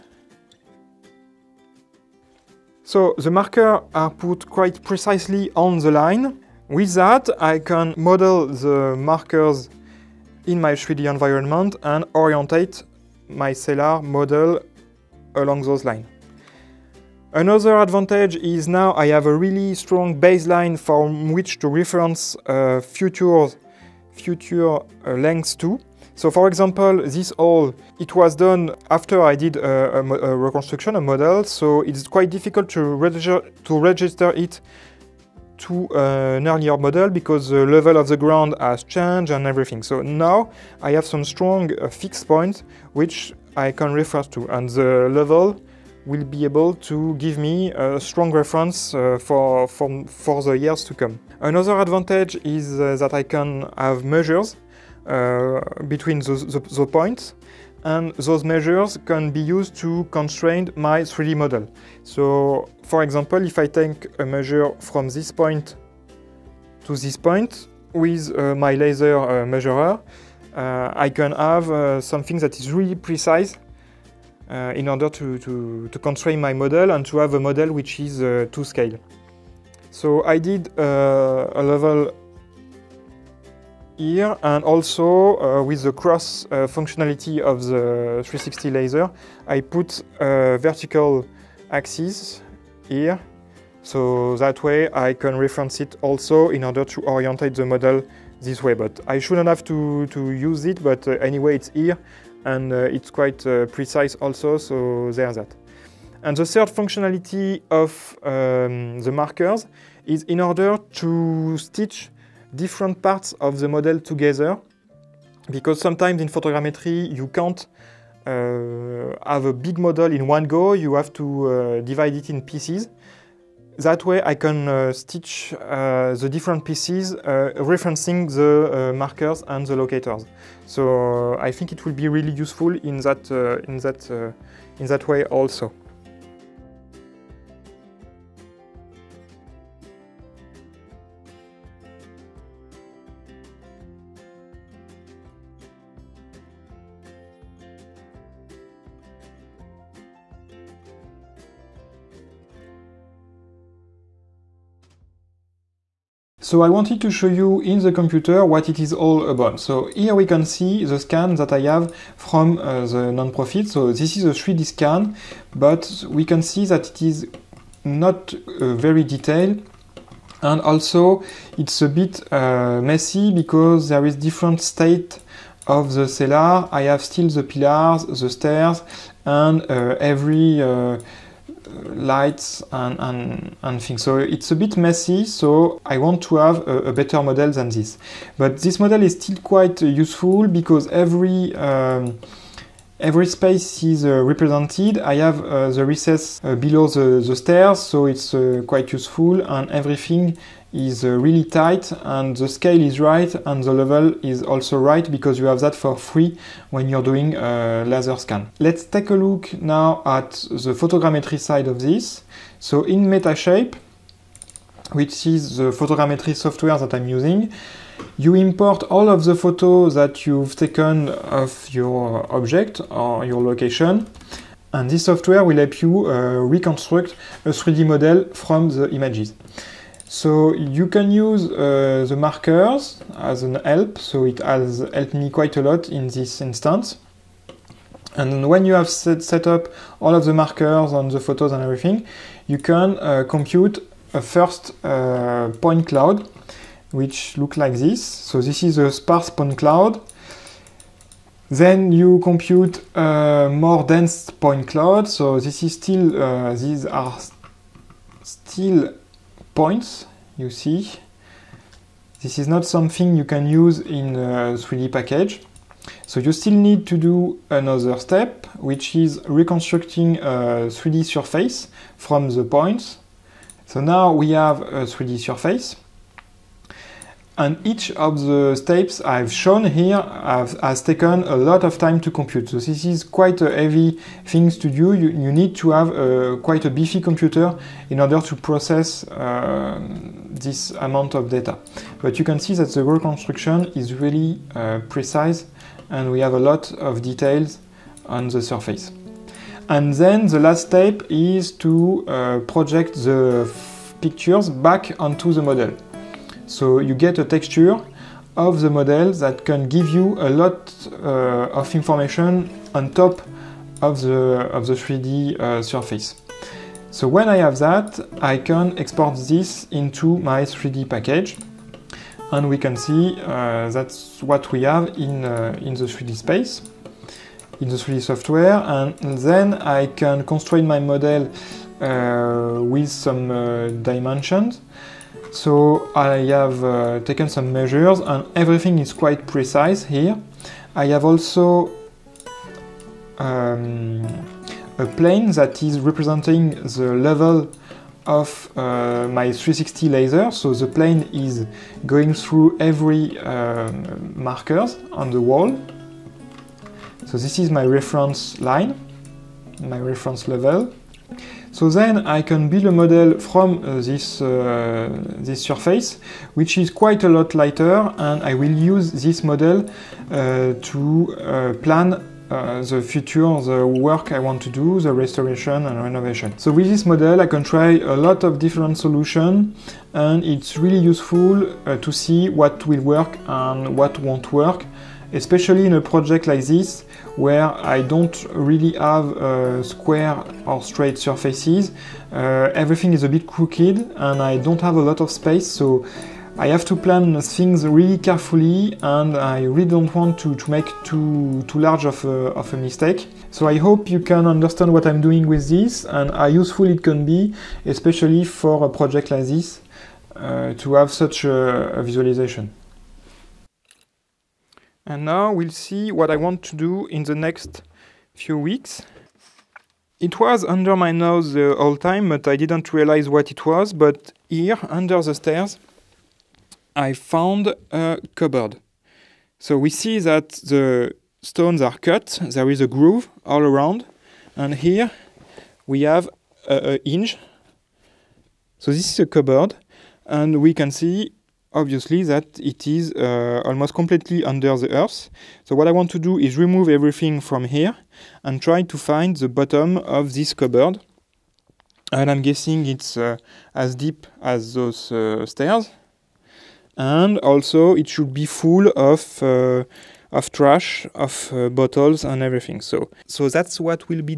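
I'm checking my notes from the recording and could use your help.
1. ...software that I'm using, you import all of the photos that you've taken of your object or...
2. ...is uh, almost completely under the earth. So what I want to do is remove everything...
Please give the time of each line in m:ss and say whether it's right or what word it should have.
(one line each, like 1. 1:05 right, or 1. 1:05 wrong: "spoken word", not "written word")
1. 3:36 right
2. 7:22 right.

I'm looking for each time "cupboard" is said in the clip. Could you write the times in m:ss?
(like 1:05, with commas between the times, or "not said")
7:08, 7:19, 7:30.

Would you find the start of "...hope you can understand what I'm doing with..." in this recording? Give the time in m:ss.
6:43.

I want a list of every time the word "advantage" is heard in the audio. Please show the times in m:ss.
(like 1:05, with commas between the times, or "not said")
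0:17, 0:51.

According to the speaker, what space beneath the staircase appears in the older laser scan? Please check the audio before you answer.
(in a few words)
the recess.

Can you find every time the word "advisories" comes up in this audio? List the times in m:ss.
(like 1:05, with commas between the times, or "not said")
not said.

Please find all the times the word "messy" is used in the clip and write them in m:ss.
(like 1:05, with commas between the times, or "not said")
2:52, 3:04.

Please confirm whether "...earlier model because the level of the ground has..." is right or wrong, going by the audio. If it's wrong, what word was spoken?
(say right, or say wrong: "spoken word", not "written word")
right.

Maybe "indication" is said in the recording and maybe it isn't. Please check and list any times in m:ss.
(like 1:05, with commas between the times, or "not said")
not said.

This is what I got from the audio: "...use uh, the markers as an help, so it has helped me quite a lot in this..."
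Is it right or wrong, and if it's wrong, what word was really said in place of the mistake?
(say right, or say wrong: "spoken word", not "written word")
right.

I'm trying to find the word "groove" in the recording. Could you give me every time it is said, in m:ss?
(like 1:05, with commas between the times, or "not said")
7:12.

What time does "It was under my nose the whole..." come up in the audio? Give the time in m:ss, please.
6:59.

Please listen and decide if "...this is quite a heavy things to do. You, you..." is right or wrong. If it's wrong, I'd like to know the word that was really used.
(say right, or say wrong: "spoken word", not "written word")
right.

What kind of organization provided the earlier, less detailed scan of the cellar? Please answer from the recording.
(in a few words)
non-profit.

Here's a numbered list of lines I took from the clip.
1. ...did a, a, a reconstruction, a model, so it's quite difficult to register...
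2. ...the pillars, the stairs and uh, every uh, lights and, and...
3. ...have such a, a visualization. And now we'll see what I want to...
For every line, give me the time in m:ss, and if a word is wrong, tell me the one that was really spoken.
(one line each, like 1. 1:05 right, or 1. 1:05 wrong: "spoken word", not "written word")
1. 0:29 right
2. 2:57 right
3. 6:50 right.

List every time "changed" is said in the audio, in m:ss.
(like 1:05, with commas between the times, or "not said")
0:38.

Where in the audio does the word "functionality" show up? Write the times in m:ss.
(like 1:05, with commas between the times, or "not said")
1:26, 1:46.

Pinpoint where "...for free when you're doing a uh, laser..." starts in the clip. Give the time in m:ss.
3:25.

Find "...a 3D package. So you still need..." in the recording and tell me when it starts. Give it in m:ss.
4:24.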